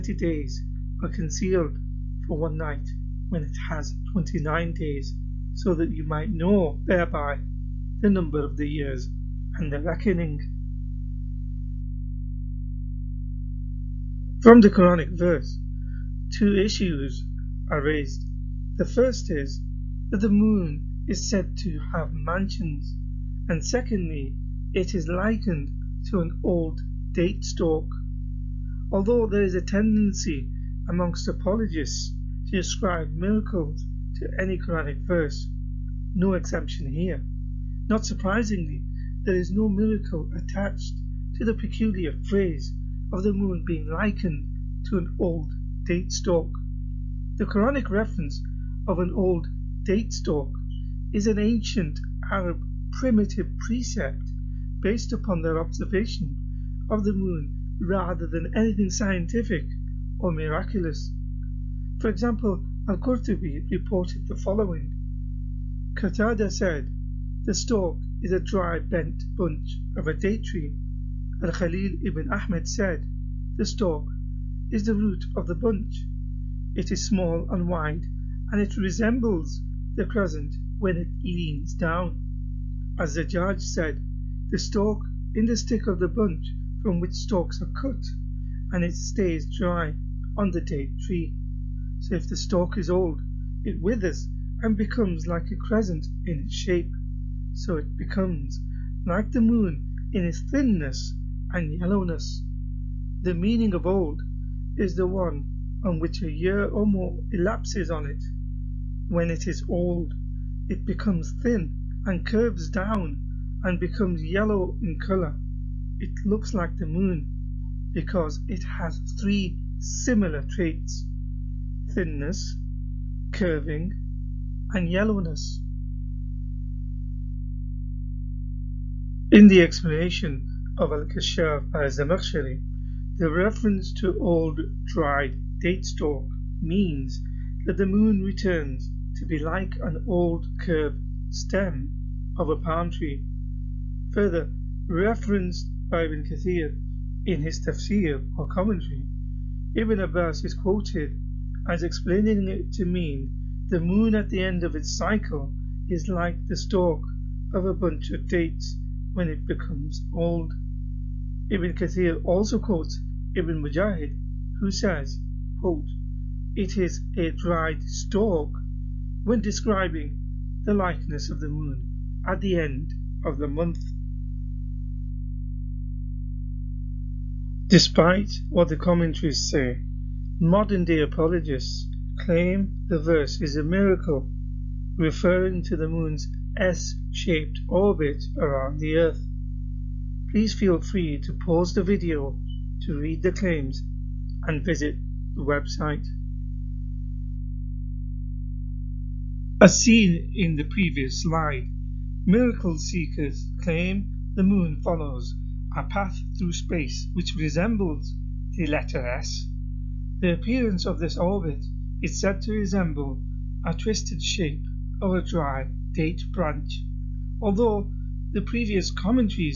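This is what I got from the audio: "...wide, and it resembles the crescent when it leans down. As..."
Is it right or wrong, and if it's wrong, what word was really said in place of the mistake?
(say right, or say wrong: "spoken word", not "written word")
right.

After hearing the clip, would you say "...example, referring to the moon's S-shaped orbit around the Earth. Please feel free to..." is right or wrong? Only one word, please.
wrong.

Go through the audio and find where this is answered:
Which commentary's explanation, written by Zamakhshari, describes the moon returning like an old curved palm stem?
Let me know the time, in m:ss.
2:10.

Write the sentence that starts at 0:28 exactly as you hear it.
Although there is a tendency amongst apologists to ascribe miracles to any Quranic verse.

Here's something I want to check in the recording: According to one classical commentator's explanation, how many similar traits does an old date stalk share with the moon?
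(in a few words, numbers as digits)
3.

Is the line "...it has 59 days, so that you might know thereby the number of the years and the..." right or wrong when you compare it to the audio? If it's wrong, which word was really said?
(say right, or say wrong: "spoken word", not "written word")
wrong: "29", not "59".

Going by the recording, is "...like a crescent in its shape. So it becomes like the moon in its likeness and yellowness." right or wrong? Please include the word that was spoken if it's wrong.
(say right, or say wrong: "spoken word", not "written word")
wrong: "thinness", not "likeness".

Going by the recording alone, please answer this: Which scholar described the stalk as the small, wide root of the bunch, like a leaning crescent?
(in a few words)
Al-Khalil ibn Ahmed.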